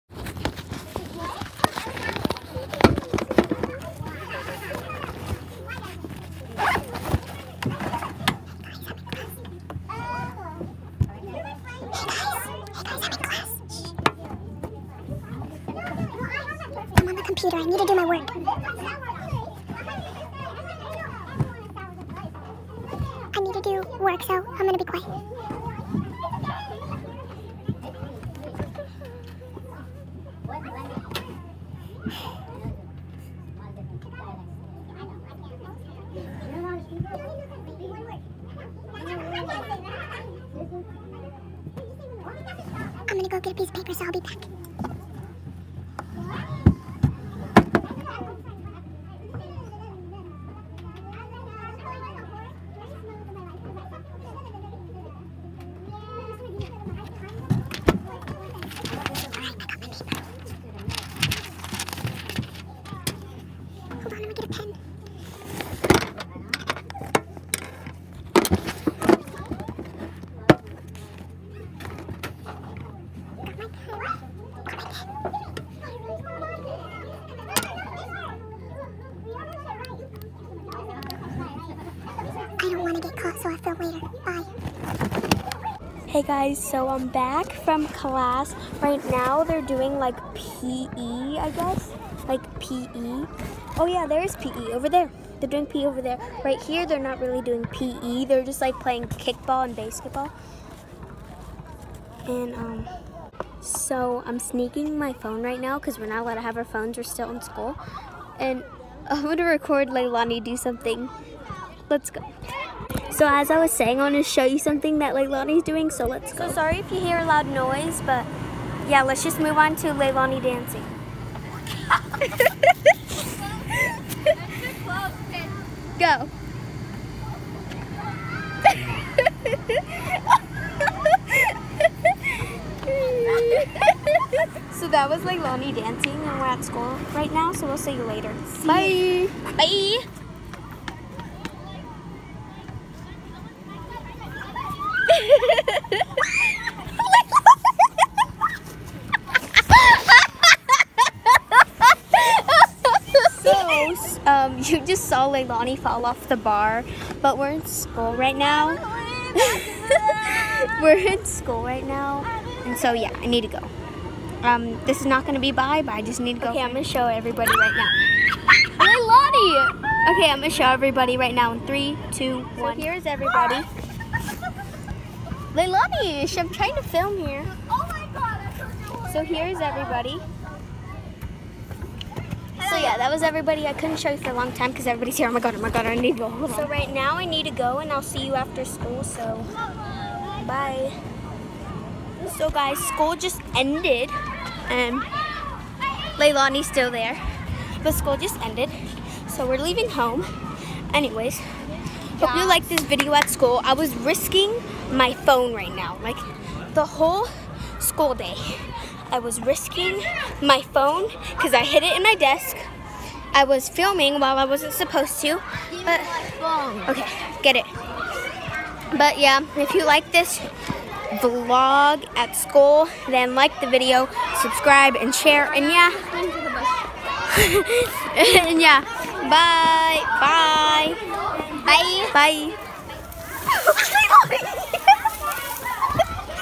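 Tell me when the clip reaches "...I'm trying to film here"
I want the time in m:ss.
2:56.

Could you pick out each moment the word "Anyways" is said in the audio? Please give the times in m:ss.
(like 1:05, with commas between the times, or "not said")
3:20.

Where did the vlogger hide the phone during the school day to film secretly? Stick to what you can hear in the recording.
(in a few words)
in my desk.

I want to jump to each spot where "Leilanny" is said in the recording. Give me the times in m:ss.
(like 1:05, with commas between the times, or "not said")
1:49, 1:55, 1:59, 2:35, 2:55, 3:16.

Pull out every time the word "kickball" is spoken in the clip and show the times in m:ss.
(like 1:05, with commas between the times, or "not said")
1:39.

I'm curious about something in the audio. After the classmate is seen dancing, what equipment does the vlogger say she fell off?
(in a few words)
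the bar.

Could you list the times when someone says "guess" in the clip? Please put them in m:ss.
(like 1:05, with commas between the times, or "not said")
1:31.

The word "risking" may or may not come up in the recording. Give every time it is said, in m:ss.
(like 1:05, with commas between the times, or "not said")
3:23, 3:29.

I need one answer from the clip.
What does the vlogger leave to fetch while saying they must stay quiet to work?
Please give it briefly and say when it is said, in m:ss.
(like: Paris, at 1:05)
a piece of paper, at 0:43.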